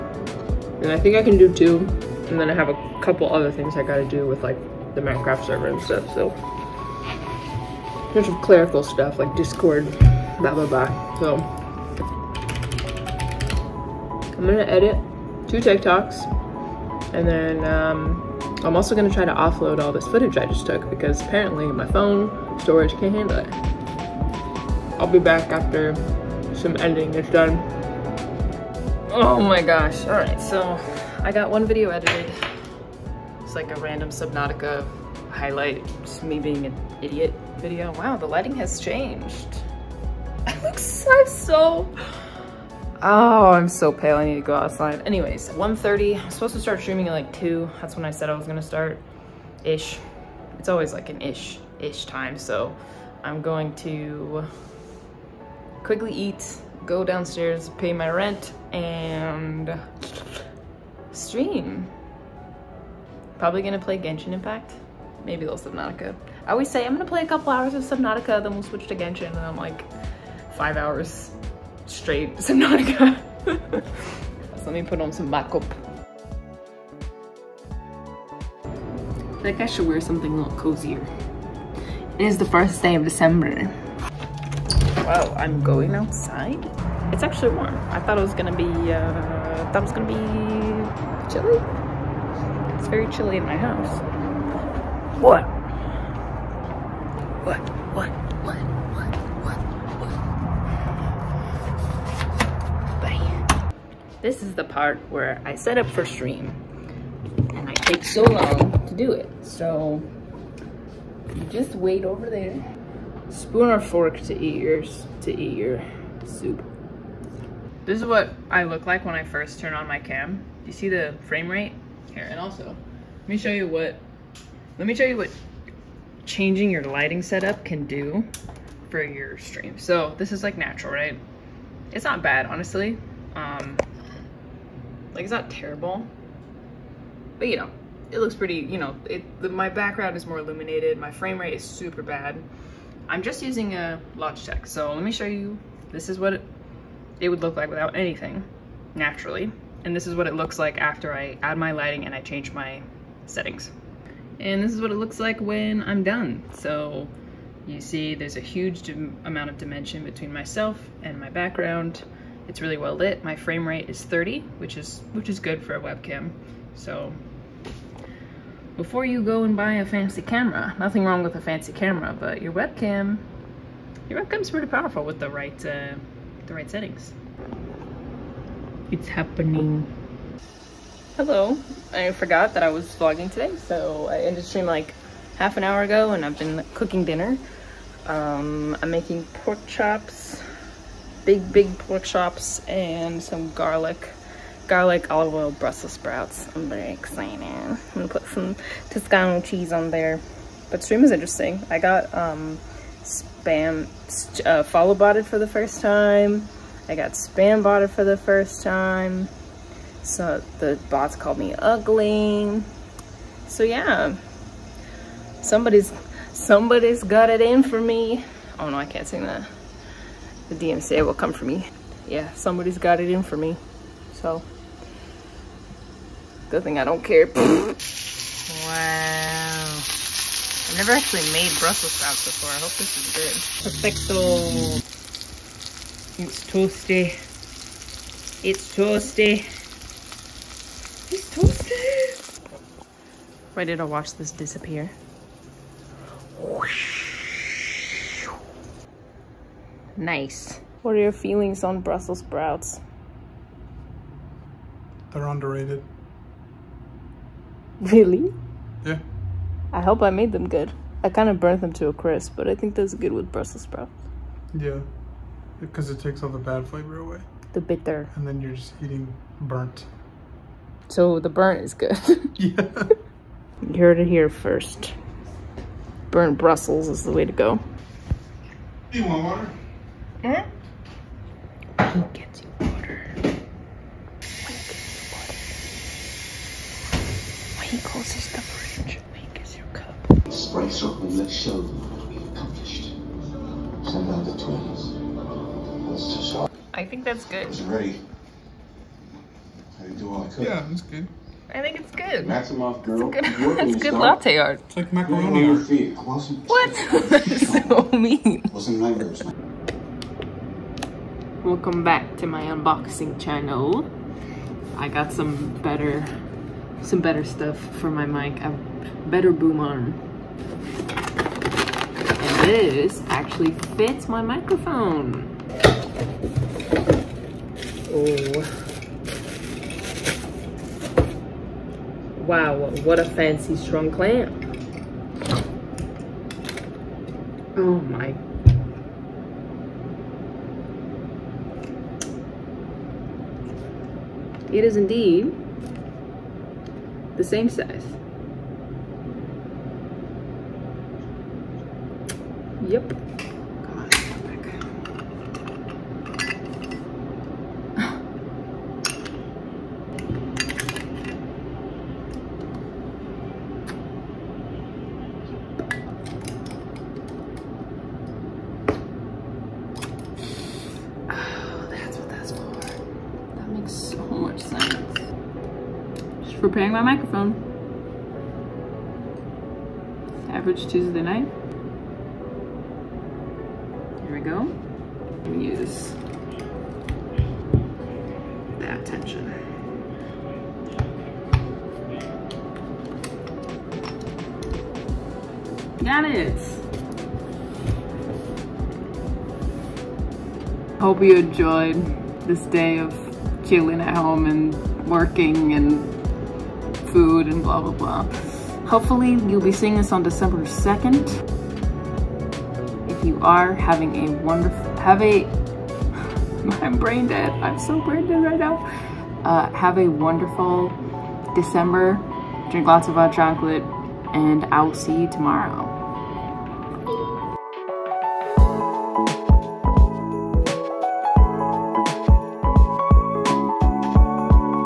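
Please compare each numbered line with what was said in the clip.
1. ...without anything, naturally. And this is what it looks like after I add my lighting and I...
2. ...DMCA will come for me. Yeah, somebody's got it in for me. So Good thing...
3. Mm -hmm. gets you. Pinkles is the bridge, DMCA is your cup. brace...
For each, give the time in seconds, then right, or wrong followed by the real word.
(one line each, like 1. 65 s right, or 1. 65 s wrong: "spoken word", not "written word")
1. 147 s right
2. 220 s right
3. 280 s wrong: "Pink", not "DMCA".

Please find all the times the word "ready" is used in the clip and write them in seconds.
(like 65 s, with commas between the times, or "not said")
243 s, 297 s.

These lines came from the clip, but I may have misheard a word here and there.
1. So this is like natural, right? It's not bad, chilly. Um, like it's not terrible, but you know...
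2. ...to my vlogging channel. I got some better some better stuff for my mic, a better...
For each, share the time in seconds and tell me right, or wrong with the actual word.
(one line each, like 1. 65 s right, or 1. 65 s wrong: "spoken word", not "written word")
1. 129 s wrong: "honestly", not "chilly"
2. 312 s wrong: "unboxing", not "vlogging".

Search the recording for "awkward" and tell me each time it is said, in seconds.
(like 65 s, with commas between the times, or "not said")
not said.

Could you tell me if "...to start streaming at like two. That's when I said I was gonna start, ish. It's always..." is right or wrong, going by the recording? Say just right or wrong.
right.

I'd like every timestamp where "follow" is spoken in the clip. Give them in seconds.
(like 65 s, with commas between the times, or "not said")
204 s.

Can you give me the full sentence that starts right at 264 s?
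Yeah, because it takes all the bad flavor away.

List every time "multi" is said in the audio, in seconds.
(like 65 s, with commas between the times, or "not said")
not said.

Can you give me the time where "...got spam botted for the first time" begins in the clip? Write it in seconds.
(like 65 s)
206 s.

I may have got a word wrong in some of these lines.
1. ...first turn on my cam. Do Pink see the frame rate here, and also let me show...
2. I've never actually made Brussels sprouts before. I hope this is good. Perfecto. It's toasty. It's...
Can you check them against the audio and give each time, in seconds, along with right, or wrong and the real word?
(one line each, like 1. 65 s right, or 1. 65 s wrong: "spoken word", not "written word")
1. 119 s wrong: "You", not "Pink"
2. 230 s right.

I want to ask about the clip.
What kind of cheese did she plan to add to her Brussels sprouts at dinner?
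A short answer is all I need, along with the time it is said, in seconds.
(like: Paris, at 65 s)
Toscano, at 198 s.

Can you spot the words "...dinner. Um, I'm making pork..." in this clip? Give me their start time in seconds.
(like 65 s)
187 s.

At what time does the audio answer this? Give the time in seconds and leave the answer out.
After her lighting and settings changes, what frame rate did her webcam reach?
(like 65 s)
164 s.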